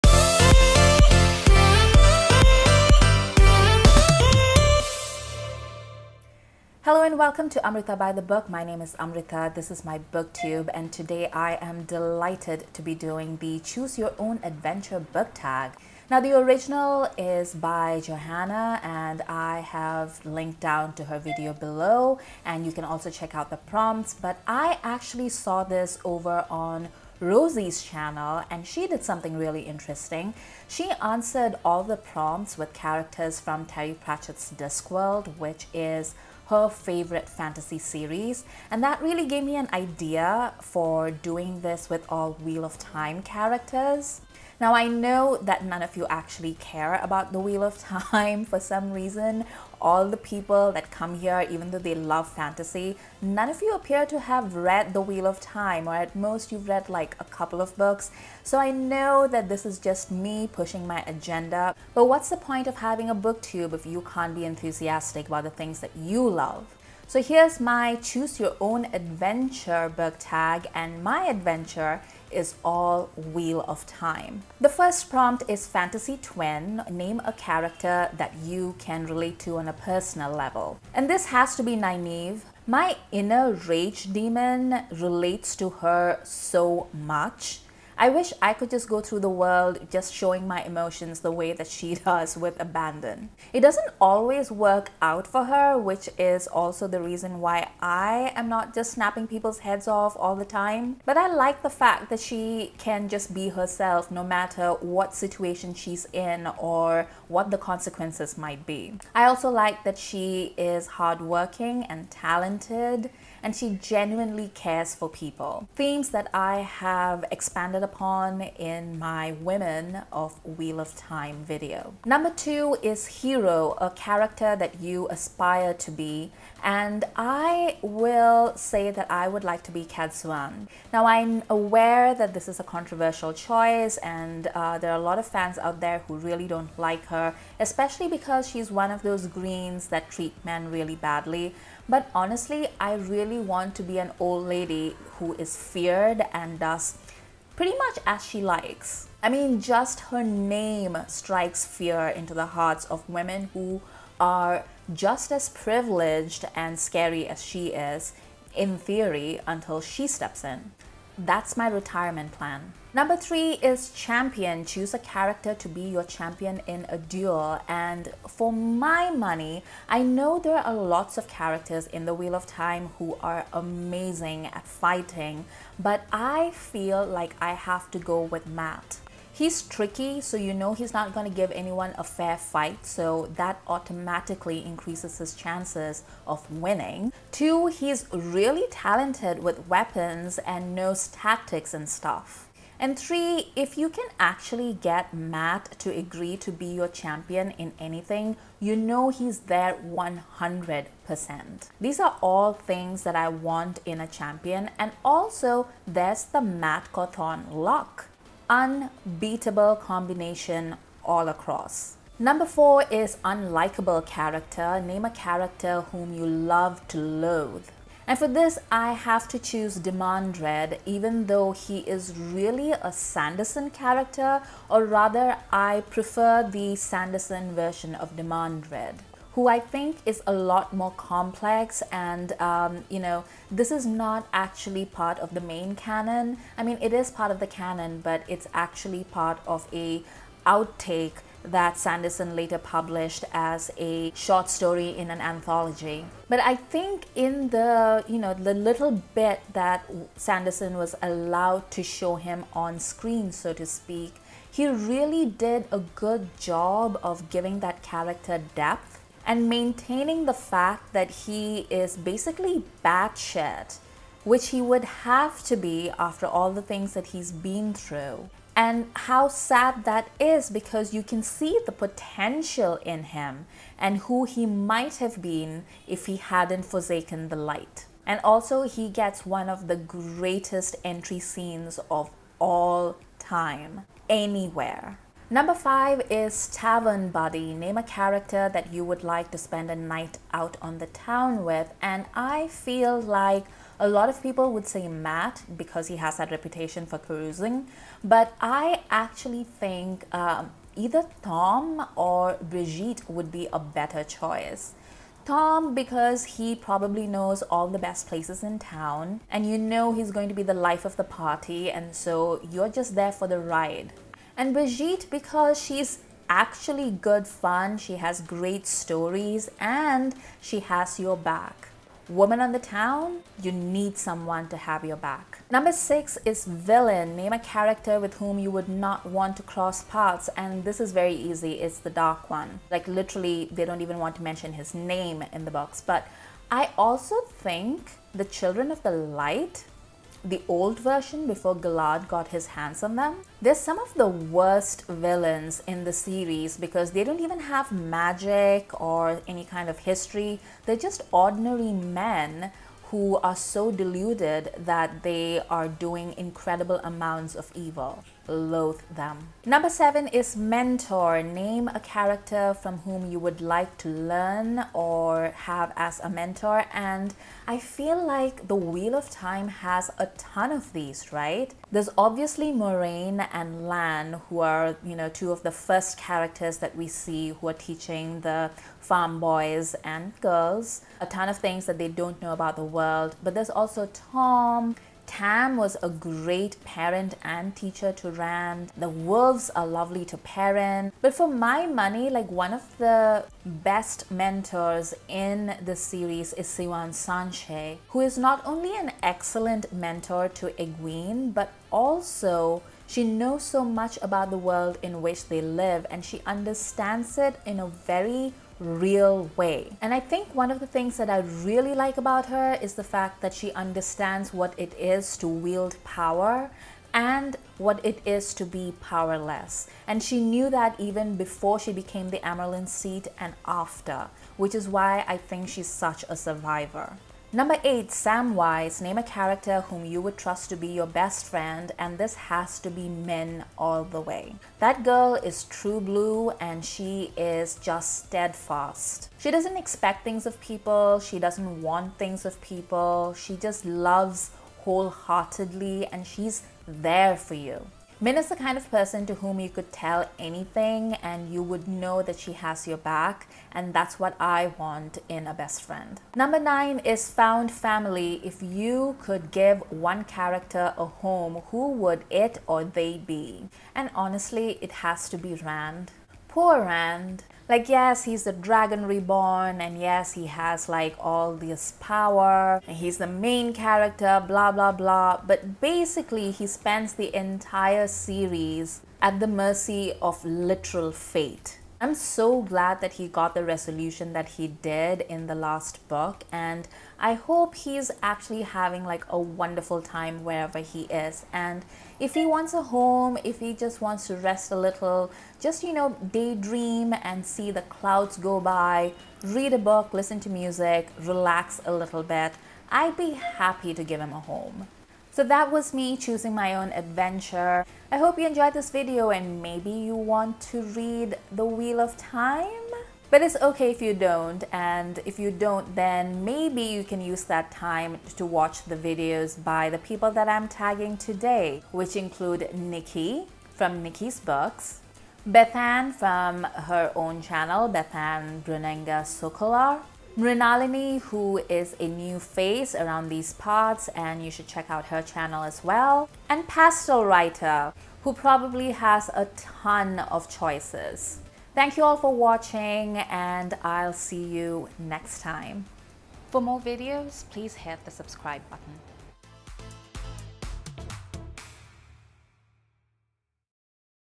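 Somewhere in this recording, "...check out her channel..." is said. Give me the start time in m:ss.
8:54.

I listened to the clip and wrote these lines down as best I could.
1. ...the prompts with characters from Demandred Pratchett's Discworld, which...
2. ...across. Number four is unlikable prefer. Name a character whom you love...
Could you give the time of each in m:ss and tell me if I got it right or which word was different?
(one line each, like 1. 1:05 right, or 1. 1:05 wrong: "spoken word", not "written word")
1. 0:31 wrong: "Terry", not "Demandred"
2. 3:31 wrong: "character", not "prefer".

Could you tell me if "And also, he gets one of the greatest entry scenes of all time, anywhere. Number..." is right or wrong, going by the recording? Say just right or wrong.
right.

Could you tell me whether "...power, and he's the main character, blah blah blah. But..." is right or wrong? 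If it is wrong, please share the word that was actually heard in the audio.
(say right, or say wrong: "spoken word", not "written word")
right.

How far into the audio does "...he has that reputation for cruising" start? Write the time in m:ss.
4:55.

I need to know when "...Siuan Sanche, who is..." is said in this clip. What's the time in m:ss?
6:36.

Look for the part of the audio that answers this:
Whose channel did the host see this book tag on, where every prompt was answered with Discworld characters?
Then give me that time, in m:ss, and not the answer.
0:27.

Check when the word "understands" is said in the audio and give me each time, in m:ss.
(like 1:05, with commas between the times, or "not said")
6:46, 6:53.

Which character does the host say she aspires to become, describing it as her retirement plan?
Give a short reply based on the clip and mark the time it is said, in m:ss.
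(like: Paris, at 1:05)
Cadsuane, at 2:09.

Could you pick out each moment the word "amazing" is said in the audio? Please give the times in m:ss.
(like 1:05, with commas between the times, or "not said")
2:53.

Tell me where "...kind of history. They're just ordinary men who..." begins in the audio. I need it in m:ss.
5:49.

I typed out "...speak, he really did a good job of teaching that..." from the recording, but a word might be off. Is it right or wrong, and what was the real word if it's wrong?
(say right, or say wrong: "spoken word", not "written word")
wrong: "giving", not "teaching".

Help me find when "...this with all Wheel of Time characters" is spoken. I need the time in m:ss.
0:41.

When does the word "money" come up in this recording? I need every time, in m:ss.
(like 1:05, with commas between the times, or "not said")
2:49, 6:31.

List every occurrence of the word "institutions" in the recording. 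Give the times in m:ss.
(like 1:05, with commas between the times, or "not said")
not said.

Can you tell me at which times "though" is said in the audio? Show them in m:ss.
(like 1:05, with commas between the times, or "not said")
0:51, 3:41.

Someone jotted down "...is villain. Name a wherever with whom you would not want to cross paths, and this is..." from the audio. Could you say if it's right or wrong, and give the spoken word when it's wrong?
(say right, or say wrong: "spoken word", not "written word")
wrong: "character", not "wherever".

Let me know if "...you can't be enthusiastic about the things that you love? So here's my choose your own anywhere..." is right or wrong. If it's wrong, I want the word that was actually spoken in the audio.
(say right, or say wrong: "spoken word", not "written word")
wrong: "adventure", not "anywhere".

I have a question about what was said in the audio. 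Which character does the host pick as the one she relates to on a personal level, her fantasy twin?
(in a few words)
Nynaeve.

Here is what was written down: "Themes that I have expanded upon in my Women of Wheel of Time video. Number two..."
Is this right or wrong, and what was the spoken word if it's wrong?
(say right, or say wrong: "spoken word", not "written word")
right.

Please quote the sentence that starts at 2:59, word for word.
He's tricky, so you know he's not going to give anyone a fair fight, so that automatically increases his chances of winning.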